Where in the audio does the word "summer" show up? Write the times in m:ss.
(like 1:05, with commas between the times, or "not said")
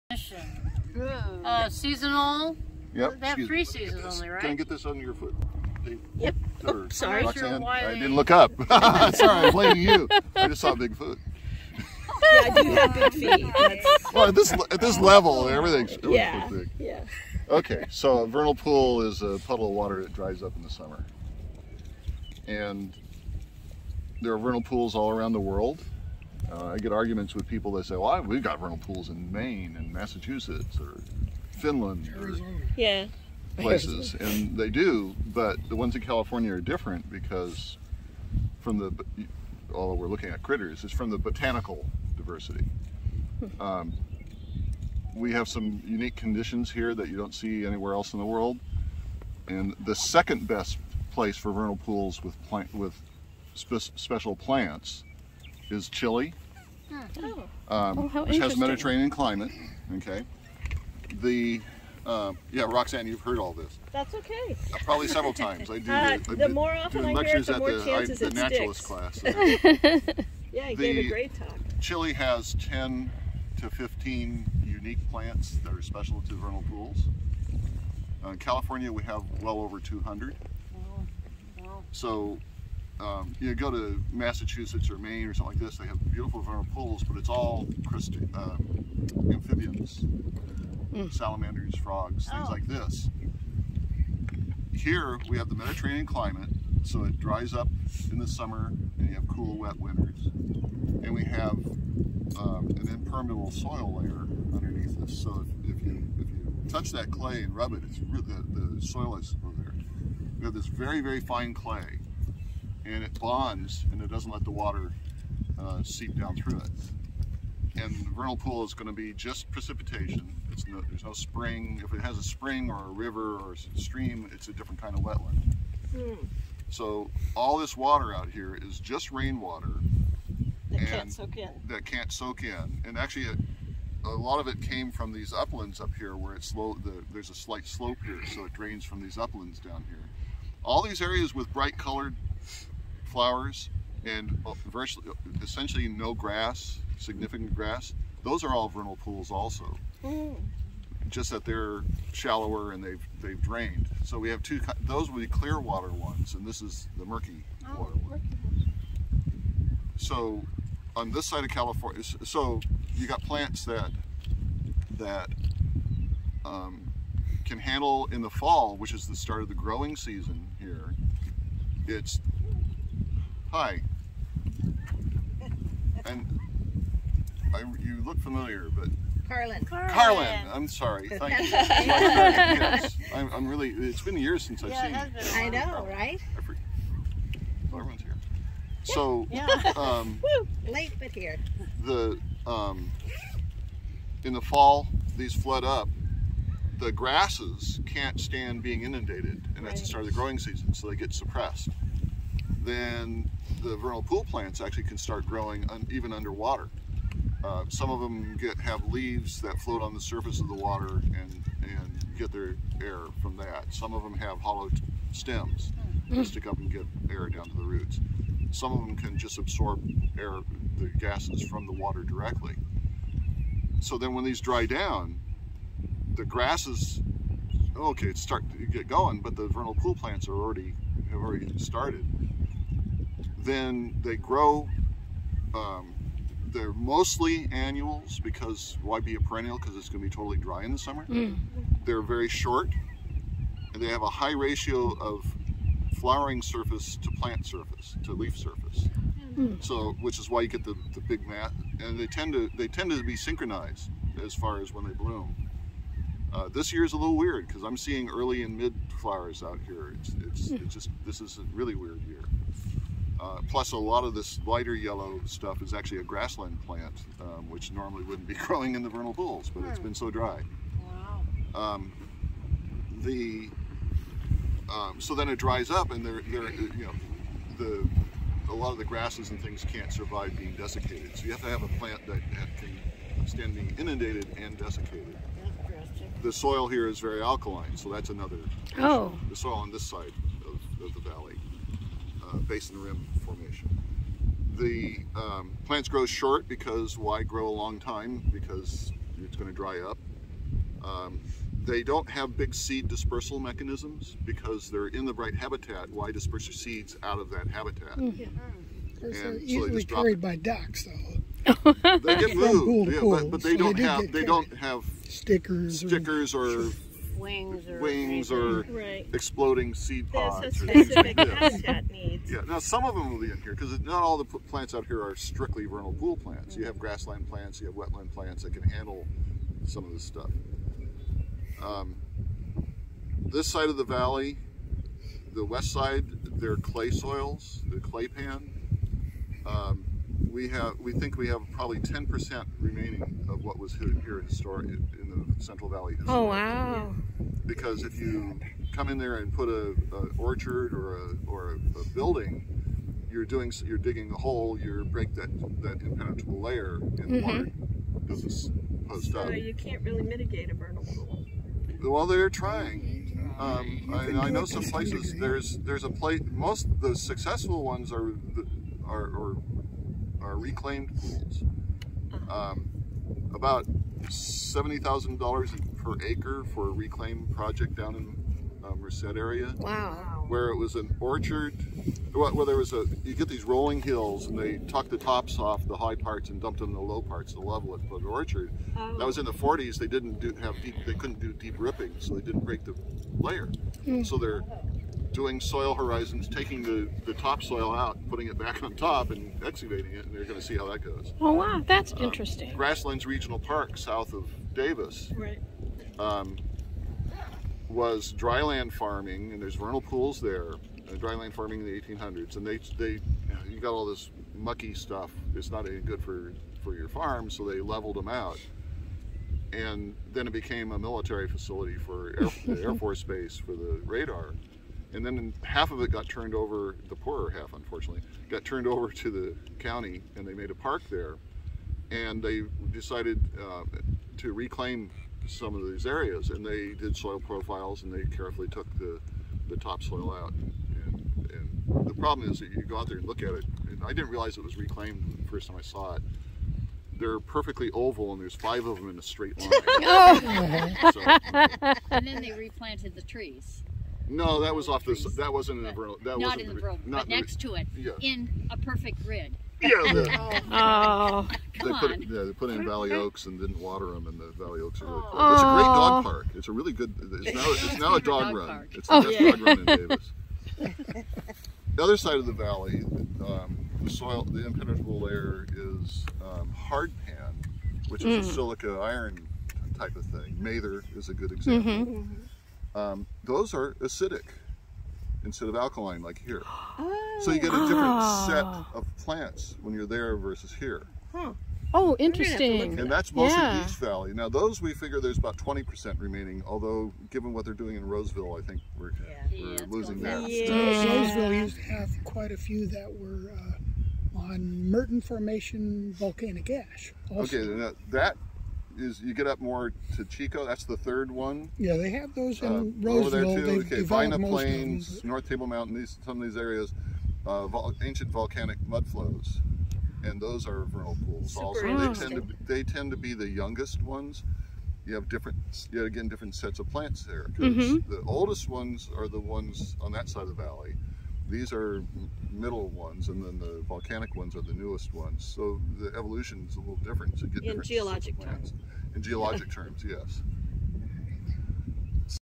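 0:20, 1:38, 4:00.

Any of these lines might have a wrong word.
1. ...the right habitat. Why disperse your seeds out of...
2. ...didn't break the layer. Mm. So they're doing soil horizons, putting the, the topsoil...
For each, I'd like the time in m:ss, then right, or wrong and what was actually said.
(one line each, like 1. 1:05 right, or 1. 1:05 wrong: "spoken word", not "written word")
1. 5:05 right
2. 6:32 wrong: "taking", not "putting".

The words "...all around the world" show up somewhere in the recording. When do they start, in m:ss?
0:24.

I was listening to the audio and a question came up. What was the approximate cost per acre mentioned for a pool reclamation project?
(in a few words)
$70,000.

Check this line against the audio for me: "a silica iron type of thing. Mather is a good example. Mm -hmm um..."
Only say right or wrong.
right.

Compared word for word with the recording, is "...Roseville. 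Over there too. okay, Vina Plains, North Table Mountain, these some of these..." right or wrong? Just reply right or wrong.
right.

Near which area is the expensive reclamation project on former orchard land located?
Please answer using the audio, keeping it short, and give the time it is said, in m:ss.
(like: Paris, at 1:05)
Merced, at 6:18.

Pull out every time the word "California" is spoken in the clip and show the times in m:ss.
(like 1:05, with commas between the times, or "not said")
0:36, 1:18, 2:41.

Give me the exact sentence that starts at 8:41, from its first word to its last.
Super also, they tend to be, they tend to be the youngest ones.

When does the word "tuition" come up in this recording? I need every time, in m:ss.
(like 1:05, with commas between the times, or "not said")
not said.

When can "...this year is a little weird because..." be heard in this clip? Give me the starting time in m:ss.
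4:16.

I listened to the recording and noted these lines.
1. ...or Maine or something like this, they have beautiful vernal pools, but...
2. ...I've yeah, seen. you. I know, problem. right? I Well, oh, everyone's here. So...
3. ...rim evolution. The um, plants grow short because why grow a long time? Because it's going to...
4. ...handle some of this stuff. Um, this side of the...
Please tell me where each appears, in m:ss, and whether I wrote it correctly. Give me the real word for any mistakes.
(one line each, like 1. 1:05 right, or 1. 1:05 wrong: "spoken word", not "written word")
1. 1:24 right
2. 3:04 right
3. 4:52 wrong: "formation", not "evolution"
4. 5:28 right.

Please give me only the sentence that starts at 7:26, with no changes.
They're perfectly oval, and there's five of them in a straight line.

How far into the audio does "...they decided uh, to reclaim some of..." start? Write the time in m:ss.
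7:12.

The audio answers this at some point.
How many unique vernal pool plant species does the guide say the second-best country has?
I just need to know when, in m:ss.
1:12.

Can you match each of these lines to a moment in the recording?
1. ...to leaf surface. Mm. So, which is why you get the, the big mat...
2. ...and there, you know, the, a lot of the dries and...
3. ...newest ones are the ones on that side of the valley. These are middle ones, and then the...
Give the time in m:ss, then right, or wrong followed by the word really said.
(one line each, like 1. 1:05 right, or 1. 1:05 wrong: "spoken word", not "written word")
1. 4:08 right
2. 4:35 wrong: "grasses", not "dries"
3. 8:48 wrong: "oldest", not "newest".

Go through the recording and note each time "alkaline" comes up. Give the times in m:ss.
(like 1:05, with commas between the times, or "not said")
4:47, 8:05.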